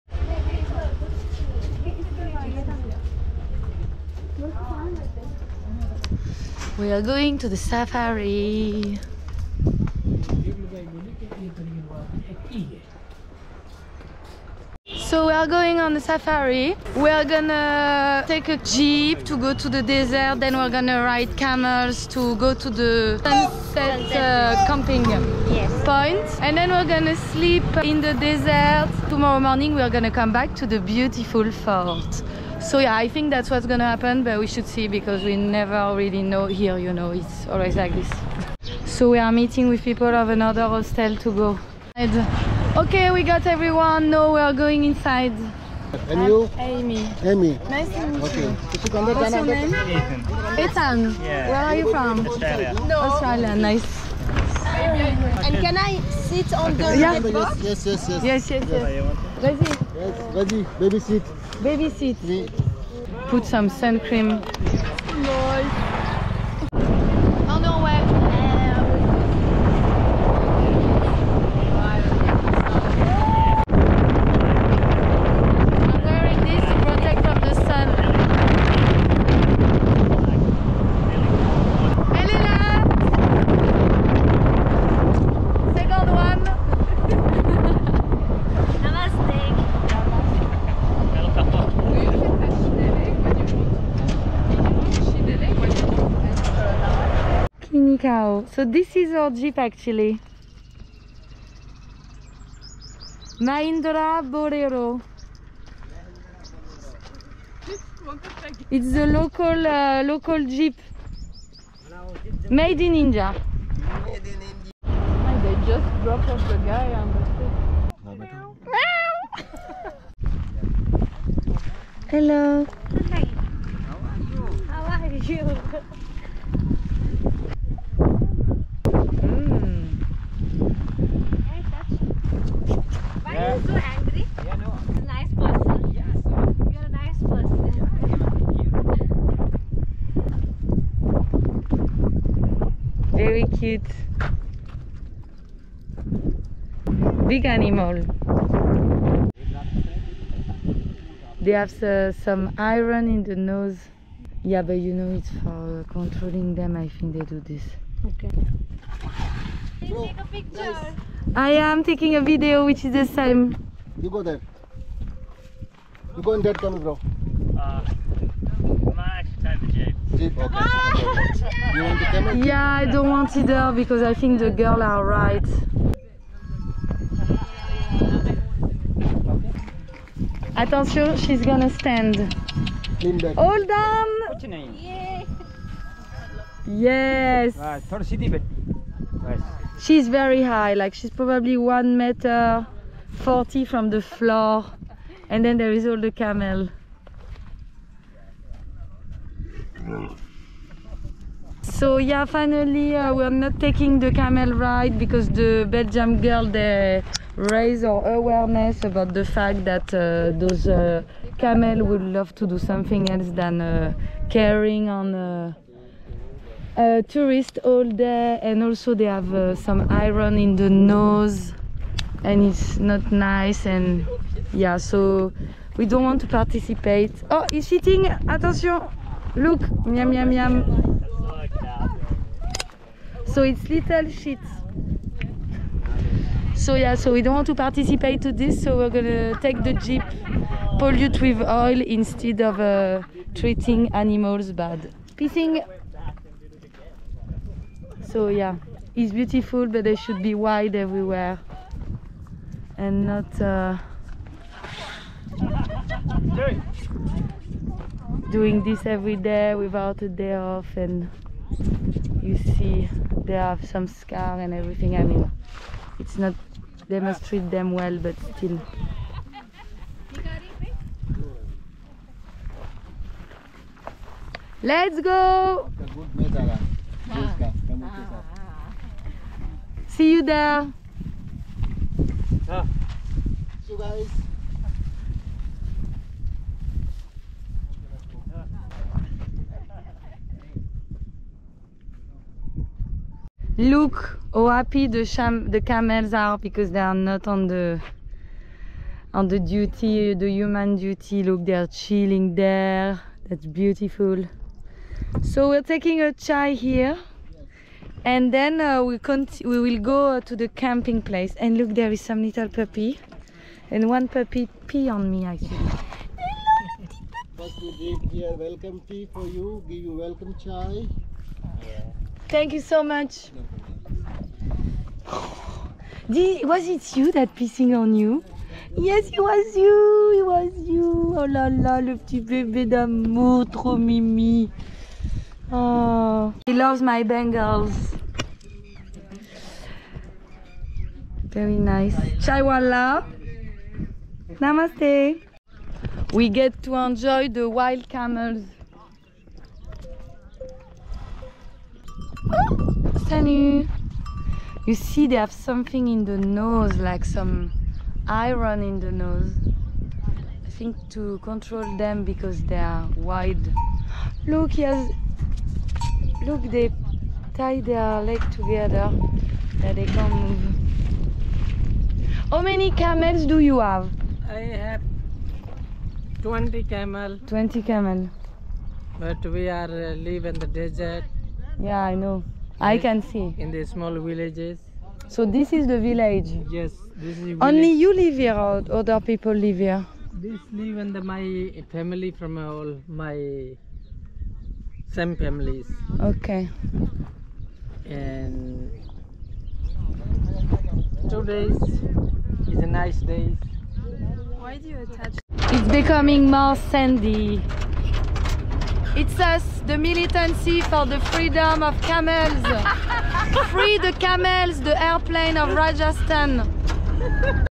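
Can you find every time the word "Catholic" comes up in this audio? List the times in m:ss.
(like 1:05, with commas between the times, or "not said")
not said.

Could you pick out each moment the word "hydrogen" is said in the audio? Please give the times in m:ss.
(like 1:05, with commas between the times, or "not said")
not said.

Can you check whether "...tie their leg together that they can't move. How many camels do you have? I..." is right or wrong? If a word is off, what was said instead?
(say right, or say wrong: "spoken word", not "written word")
right.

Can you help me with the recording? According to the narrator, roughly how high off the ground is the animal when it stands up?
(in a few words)
1 meter 40.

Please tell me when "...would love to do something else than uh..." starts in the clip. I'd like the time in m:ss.
3:31.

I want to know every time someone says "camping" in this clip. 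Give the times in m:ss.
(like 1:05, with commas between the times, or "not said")
0:24, 5:10.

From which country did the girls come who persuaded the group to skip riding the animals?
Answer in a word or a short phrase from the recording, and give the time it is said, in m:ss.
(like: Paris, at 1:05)
Belgium, at 3:25.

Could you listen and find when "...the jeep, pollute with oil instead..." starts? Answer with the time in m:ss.
3:59.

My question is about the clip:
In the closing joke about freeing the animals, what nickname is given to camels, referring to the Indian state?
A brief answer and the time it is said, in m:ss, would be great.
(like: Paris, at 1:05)
The airplane of Rajasthan, at 6:54.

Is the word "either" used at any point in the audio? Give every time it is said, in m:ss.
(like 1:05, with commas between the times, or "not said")
2:53.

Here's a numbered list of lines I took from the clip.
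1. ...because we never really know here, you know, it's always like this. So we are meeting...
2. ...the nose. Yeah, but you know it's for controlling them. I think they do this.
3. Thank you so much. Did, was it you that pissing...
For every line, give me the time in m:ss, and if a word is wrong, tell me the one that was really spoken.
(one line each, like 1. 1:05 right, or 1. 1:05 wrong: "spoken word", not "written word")
1. 0:34 right
2. 2:33 right
3. 5:22 right.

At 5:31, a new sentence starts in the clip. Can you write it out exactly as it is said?
Oh là là, le petit bébé d'amour, trop mimi.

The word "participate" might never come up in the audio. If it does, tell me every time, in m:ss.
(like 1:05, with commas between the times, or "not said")
3:46, 3:57.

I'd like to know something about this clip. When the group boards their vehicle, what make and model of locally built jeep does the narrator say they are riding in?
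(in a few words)
Mahindra Bolero.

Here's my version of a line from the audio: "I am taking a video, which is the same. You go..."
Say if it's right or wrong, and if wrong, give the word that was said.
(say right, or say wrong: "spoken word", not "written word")
right.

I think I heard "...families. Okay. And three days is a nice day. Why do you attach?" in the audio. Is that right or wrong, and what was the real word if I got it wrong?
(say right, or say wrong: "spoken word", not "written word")
wrong: "two", not "three".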